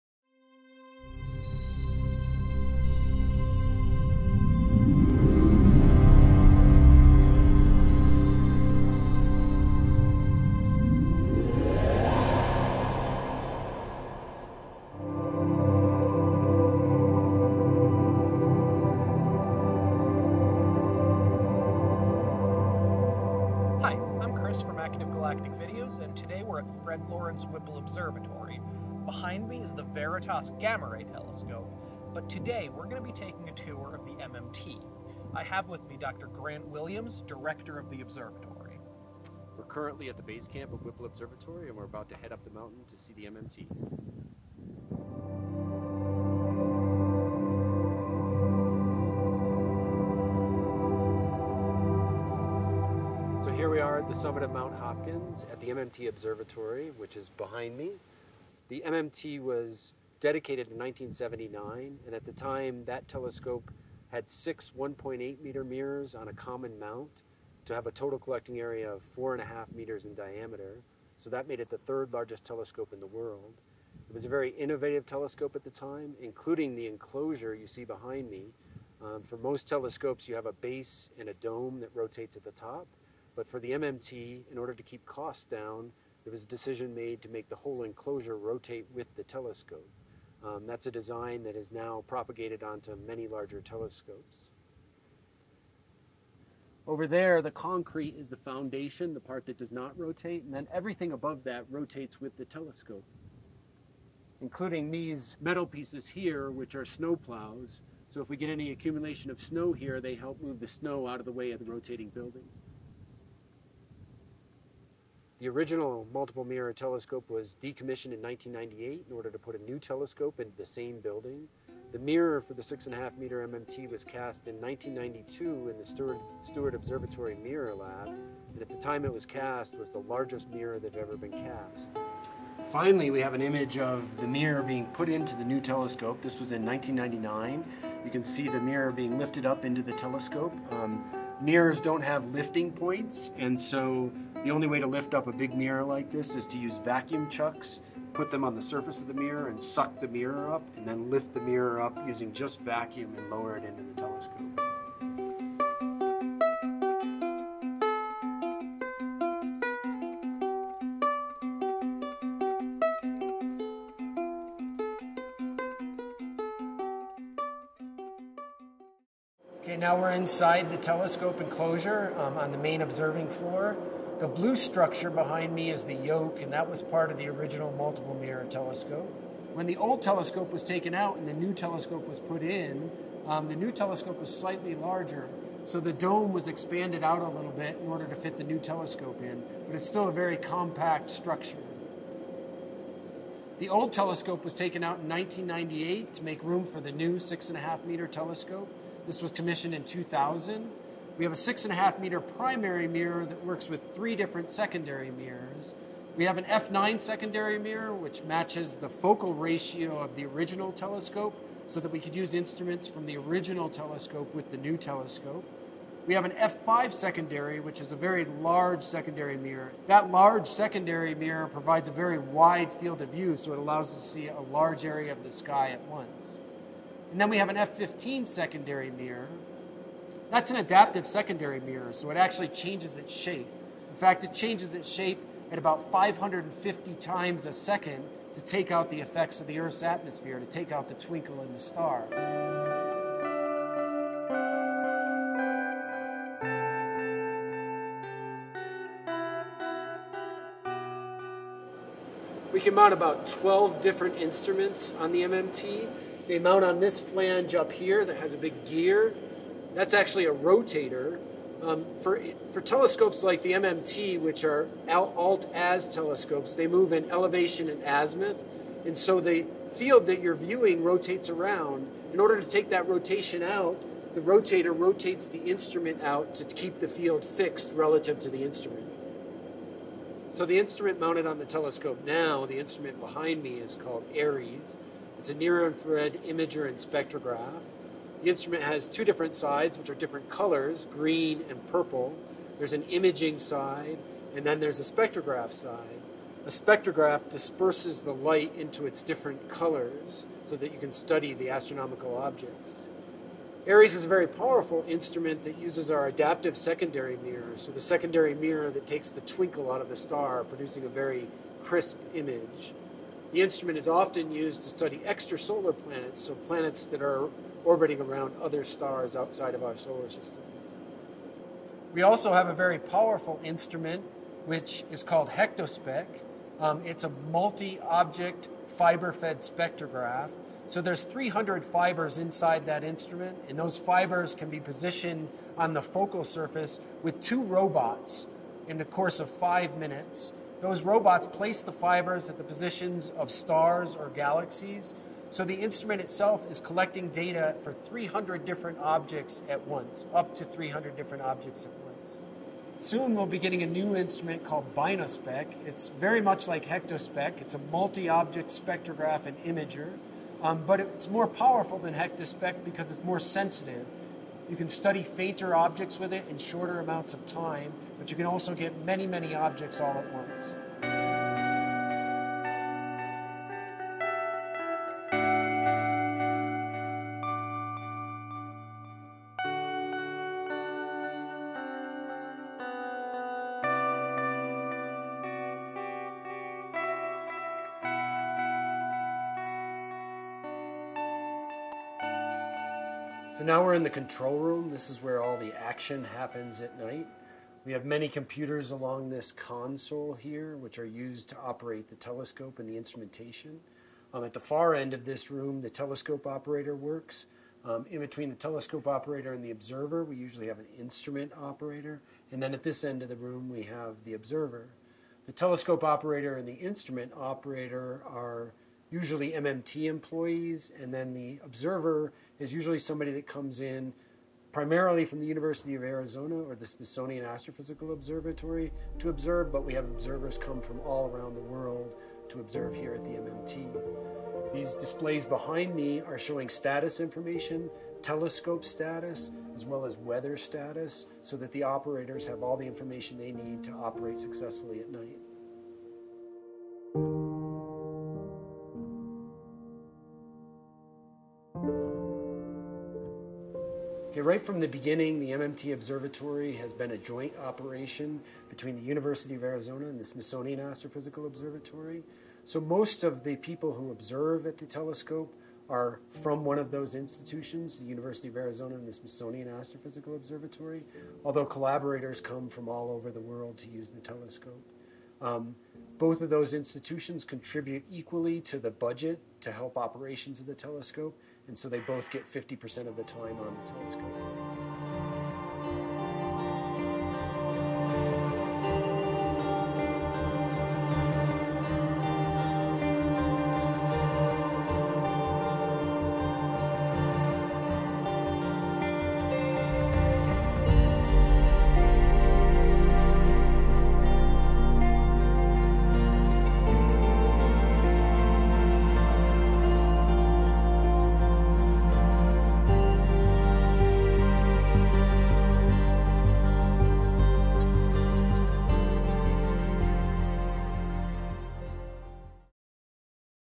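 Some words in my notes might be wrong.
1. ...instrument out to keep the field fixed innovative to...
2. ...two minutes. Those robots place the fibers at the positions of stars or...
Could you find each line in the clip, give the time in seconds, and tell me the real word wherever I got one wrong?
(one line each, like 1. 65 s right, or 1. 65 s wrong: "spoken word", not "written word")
1. 275 s wrong: "relative", not "innovative"
2. 339 s wrong: "five", not "two".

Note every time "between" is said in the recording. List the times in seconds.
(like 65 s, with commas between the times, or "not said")
407 s, 458 s.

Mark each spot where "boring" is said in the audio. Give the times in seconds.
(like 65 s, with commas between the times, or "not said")
not said.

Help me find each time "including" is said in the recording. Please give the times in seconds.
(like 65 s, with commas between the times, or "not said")
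76 s, 104 s.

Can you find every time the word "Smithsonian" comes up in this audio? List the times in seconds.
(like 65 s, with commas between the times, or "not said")
426 s, 460 s, 468 s.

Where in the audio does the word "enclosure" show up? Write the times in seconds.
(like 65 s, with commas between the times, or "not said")
76 s, 87 s, 171 s.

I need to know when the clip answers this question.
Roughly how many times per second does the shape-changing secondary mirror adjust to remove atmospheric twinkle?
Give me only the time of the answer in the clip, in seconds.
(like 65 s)
235 s.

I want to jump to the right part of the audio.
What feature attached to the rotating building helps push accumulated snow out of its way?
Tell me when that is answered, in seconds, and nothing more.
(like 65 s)
106 s.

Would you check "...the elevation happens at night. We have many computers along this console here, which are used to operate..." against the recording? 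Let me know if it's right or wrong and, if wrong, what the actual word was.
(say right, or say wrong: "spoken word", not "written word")
wrong: "action", not "elevation".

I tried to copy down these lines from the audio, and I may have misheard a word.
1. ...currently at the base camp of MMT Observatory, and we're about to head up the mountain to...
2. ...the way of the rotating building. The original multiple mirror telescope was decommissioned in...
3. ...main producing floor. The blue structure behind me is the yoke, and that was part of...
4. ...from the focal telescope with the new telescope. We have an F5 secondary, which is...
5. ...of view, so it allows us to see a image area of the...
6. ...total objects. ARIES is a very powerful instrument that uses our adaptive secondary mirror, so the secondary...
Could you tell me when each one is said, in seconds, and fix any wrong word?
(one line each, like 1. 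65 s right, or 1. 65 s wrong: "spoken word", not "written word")
1. 39 s wrong: "Whipple", not "MMT"
2. 111 s right
3. 172 s wrong: "observing", not "producing"
4. 212 s wrong: "original", not "focal"
5. 223 s wrong: "large", not "image"
6. 301 s wrong: "astronomical", not "total".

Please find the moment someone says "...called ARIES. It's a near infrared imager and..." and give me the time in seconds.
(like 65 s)
283 s.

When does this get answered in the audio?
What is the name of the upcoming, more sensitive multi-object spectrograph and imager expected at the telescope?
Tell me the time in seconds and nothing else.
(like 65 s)
354 s.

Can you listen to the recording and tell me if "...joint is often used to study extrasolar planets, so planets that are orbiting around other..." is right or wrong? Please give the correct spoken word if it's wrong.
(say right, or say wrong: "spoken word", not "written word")
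wrong: "instrument", not "joint".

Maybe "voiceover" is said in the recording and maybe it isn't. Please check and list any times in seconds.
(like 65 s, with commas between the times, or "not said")
not said.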